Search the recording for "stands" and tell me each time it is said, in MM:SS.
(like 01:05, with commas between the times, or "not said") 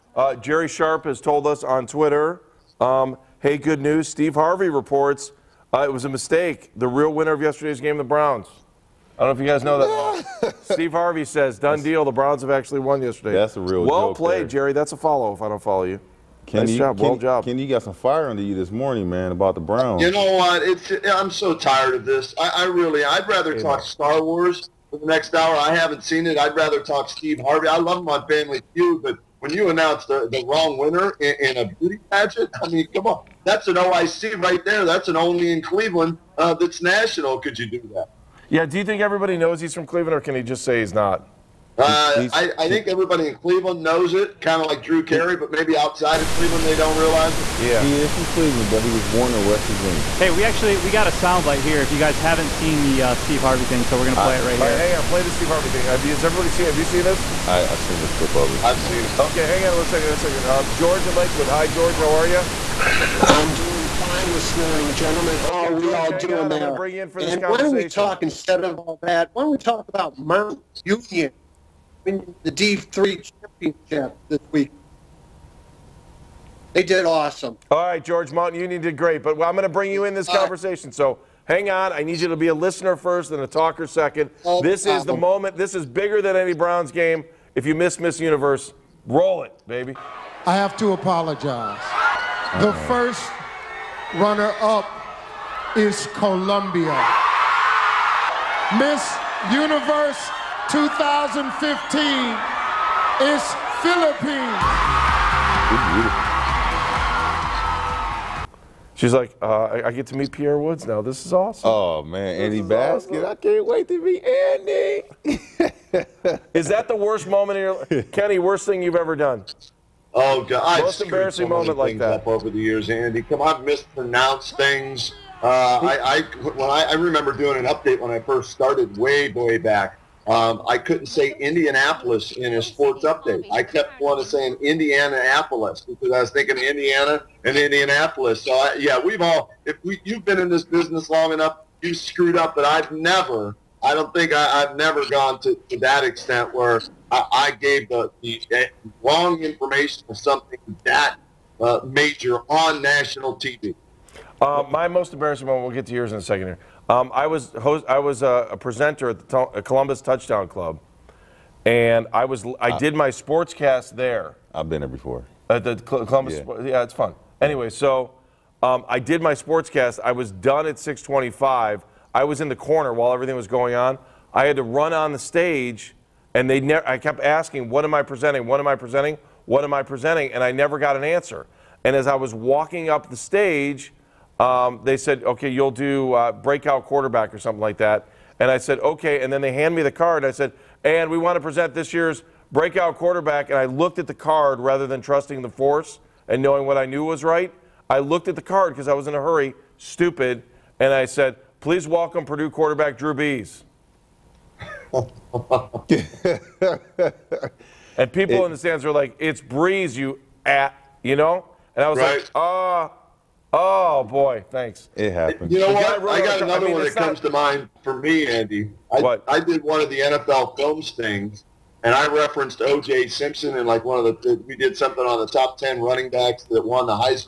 03:28.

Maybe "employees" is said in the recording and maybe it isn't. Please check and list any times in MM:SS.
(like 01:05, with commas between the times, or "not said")
not said.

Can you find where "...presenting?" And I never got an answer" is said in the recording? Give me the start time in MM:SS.
02:59.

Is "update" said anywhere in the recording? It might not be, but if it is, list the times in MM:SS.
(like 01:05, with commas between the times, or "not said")
02:07, 02:13.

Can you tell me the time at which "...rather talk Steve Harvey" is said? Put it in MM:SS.
00:26.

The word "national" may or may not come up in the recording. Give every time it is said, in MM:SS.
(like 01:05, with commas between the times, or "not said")
00:36, 02:32.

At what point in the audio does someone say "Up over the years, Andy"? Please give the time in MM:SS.
02:02.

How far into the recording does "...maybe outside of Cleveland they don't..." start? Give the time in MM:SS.
00:45.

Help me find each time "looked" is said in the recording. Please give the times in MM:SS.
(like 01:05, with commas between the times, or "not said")
03:13, 03:17.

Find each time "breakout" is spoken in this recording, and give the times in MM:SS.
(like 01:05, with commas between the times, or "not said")
03:06, 03:12.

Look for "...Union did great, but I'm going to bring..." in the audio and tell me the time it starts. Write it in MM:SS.
01:18.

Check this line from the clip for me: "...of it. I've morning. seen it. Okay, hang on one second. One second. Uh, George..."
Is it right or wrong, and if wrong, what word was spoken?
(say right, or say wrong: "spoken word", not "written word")
right.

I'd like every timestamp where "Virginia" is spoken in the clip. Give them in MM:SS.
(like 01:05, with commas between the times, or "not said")
00:49.